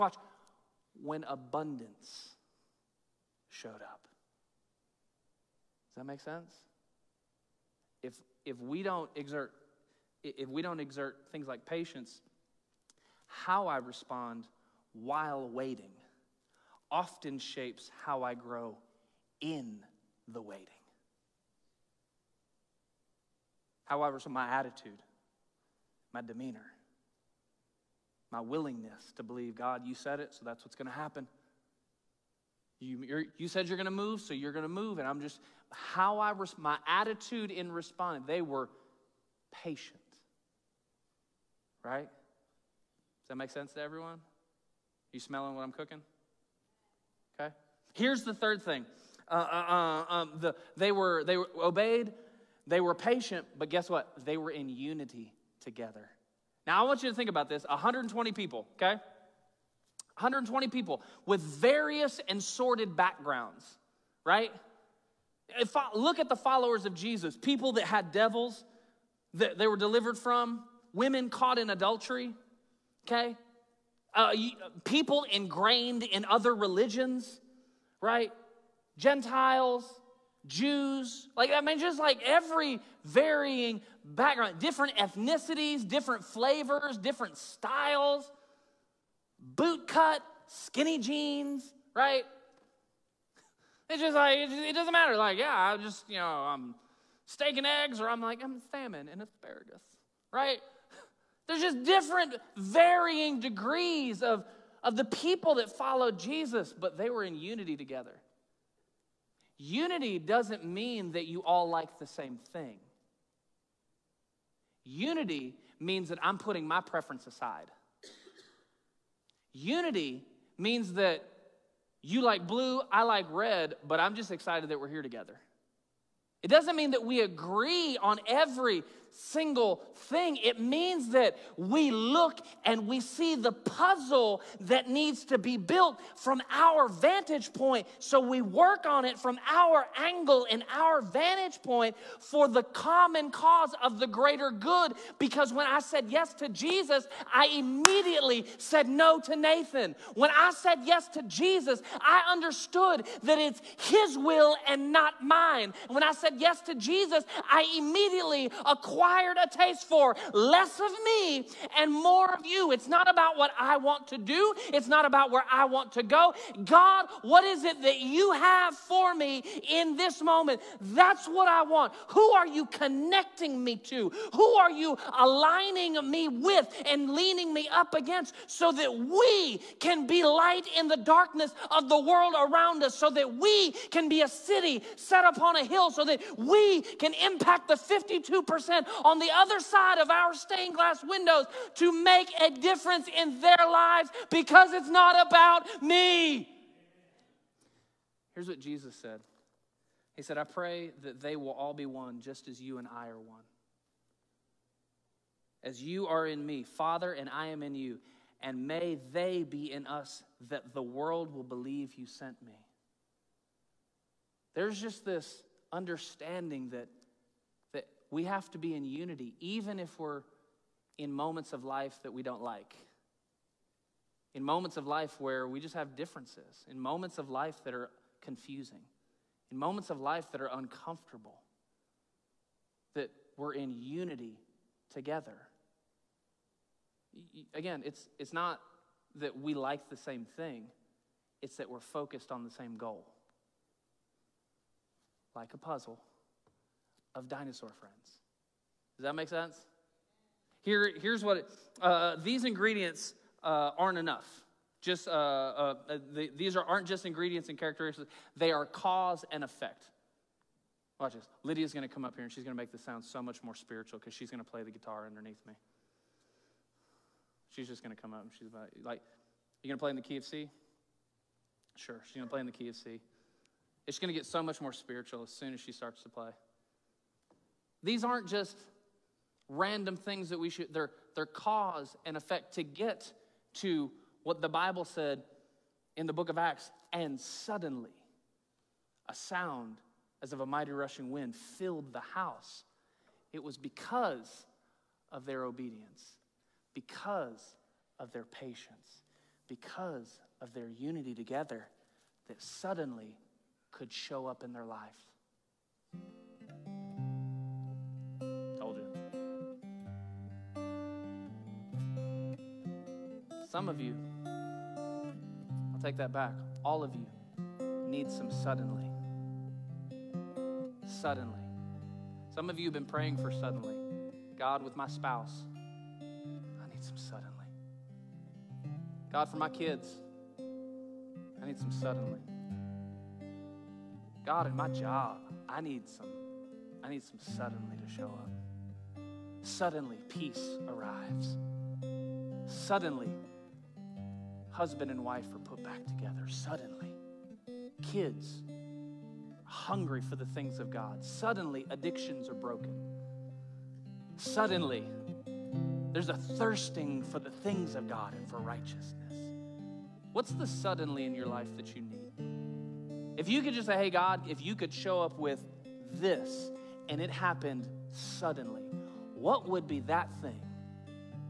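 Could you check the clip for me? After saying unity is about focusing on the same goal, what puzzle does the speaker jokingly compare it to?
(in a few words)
dinosaur friends.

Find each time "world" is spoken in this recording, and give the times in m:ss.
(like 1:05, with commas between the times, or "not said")
3:01, 3:30.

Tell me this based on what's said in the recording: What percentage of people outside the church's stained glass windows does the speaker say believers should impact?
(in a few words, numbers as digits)
52%.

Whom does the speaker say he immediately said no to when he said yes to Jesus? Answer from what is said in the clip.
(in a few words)
Nathan.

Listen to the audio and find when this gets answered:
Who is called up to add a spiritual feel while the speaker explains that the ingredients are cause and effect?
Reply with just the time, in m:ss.
4:21.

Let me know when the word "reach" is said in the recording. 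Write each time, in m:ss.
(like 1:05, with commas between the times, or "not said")
not said.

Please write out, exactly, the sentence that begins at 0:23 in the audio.
However, so my attitude, my demeanor, my willingness to believe God, you said it, so that's what's going to happen.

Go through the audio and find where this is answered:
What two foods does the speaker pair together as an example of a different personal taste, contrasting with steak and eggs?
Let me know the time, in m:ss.
1:38.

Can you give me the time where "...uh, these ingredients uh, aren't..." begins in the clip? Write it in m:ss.
4:11.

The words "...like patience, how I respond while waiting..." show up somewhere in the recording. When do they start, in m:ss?
0:11.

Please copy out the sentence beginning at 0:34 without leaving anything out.
And I'm just, how I, res- my attitude in responding, they were patient.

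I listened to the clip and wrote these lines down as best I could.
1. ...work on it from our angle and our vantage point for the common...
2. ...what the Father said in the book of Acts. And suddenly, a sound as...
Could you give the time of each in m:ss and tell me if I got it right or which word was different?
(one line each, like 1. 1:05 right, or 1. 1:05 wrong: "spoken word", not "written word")
1. 2:18 right
2. 4:44 wrong: "Bible", not "Father".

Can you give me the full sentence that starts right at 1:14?
Uh, people ingrained in other religions, right?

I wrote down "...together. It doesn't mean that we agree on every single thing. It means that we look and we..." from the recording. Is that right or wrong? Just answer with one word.
right.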